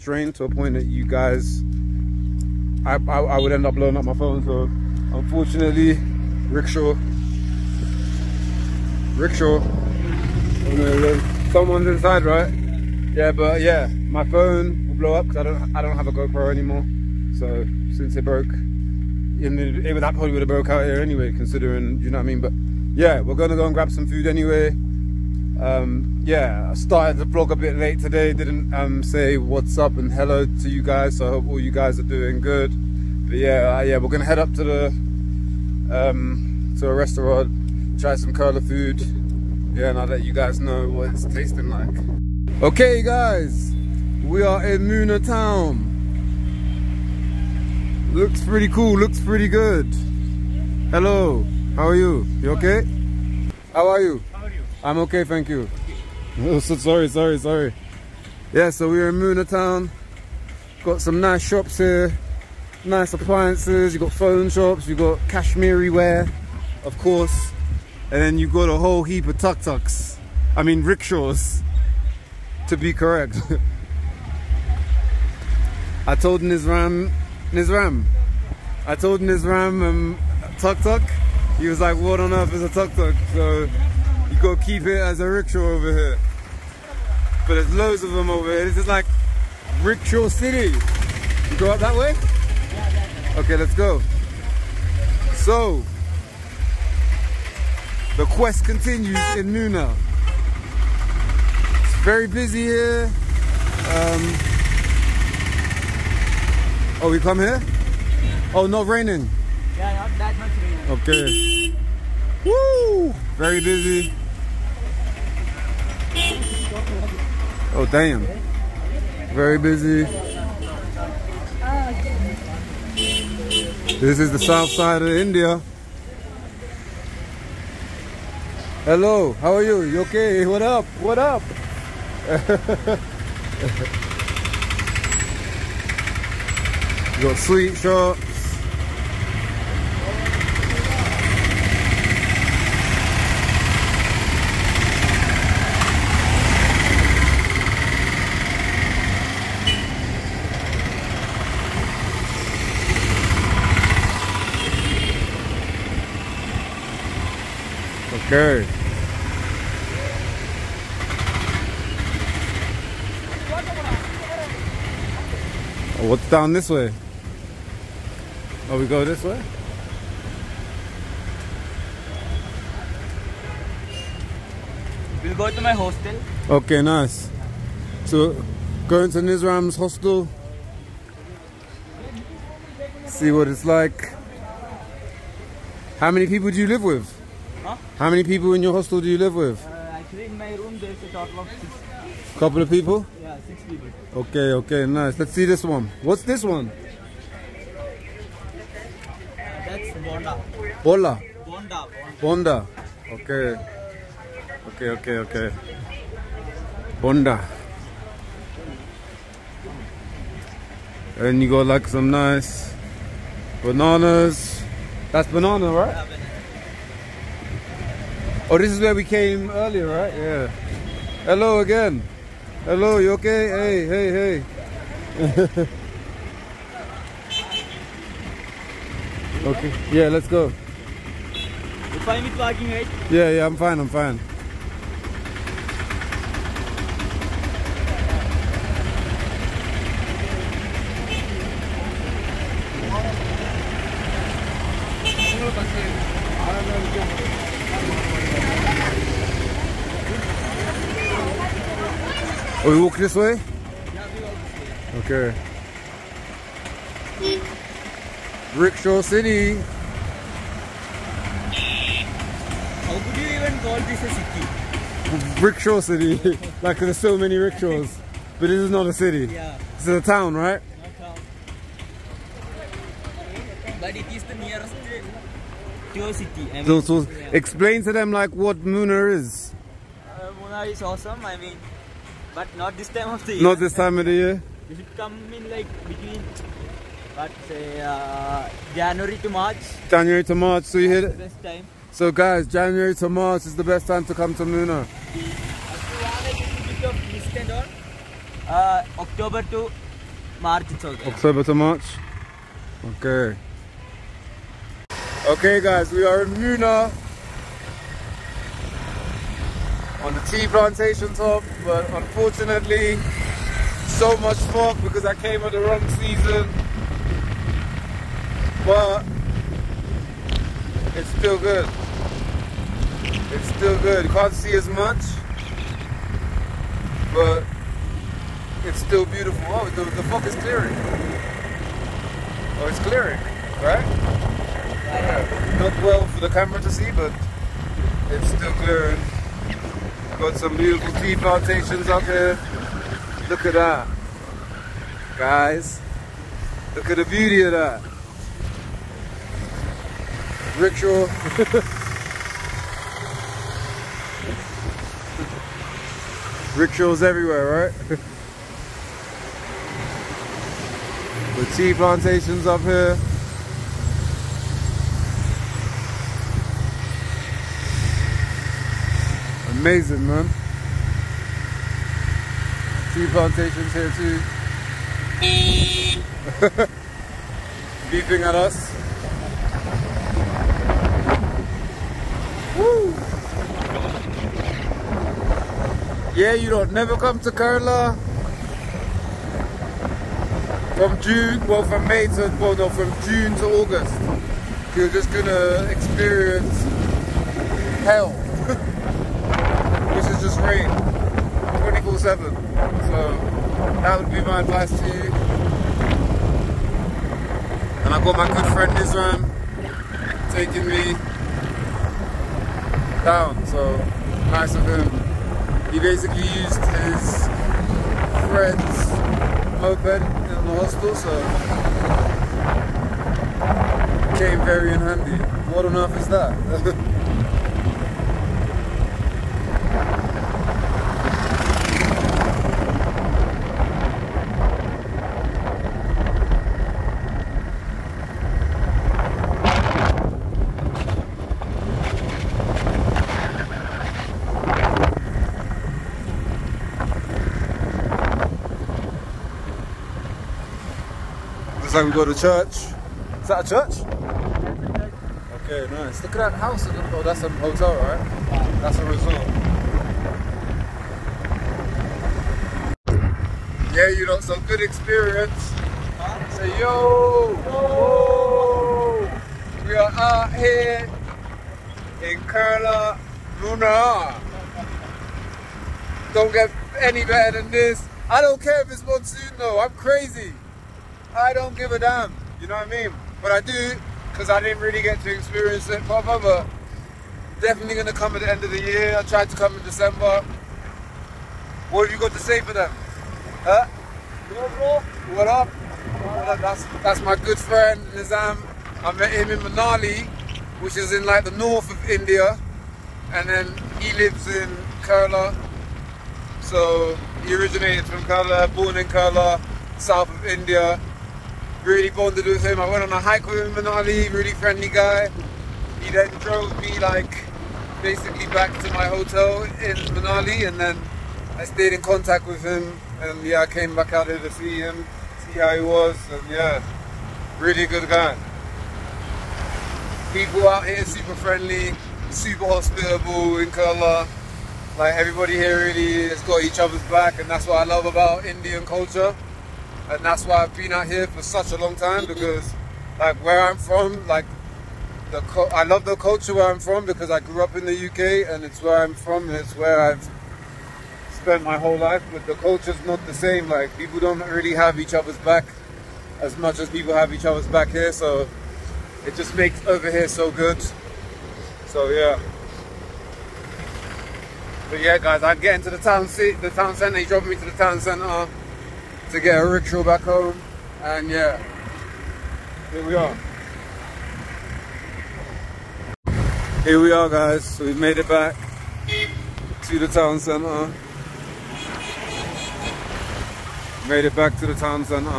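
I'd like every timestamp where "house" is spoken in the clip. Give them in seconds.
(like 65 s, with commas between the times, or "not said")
456 s.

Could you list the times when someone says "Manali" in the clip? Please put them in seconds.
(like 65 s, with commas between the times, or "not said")
499 s, 519 s.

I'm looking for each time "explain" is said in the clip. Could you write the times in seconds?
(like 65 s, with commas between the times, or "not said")
277 s.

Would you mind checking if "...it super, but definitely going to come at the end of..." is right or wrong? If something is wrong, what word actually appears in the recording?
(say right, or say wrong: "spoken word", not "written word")
wrong: "proper", not "super".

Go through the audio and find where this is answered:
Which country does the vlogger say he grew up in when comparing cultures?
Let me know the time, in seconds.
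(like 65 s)
547 s.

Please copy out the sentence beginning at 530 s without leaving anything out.
People out here super friendly, super hospitable in Kerala.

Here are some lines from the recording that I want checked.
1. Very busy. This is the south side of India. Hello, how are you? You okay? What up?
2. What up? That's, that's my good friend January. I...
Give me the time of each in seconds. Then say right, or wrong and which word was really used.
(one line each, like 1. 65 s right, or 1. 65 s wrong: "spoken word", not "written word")
1. 119 s right
2. 495 s wrong: "Nizam", not "January".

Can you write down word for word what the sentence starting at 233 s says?
Yeah, yeah, I'm fine, I'm fine.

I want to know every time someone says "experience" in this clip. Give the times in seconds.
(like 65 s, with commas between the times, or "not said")
395 s, 464 s, 485 s.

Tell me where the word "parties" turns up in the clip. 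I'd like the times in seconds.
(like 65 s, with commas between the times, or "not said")
not said.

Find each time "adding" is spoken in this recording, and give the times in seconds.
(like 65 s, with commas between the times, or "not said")
not said.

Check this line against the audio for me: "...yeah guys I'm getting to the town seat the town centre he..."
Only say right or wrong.
right.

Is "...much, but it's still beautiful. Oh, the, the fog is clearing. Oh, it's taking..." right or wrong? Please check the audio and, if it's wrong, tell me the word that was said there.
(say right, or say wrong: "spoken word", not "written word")
wrong: "clearing", not "taking".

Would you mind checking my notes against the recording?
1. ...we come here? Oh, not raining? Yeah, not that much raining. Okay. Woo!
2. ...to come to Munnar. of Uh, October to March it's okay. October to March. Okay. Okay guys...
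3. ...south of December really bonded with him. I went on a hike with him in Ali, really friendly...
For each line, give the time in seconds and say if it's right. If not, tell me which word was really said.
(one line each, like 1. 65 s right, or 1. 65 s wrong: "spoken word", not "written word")
1. 107 s right
2. 294 s right
3. 509 s wrong: "India", not "December".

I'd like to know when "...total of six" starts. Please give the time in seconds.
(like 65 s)
191 s.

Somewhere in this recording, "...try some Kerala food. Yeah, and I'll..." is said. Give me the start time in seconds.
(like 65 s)
37 s.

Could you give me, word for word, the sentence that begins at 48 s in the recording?
Looks pretty cool, looks pretty good.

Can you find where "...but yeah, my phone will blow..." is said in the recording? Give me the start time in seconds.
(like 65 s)
13 s.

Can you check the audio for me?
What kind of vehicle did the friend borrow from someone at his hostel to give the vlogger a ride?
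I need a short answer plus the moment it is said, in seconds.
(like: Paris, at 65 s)
moped, at 419 s.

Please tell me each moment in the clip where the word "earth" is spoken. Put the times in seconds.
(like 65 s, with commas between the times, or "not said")
82 s, 425 s.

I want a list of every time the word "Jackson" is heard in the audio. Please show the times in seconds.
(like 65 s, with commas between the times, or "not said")
not said.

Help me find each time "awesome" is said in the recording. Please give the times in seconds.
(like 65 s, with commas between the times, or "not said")
280 s.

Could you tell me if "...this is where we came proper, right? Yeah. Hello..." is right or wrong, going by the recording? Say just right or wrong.
wrong.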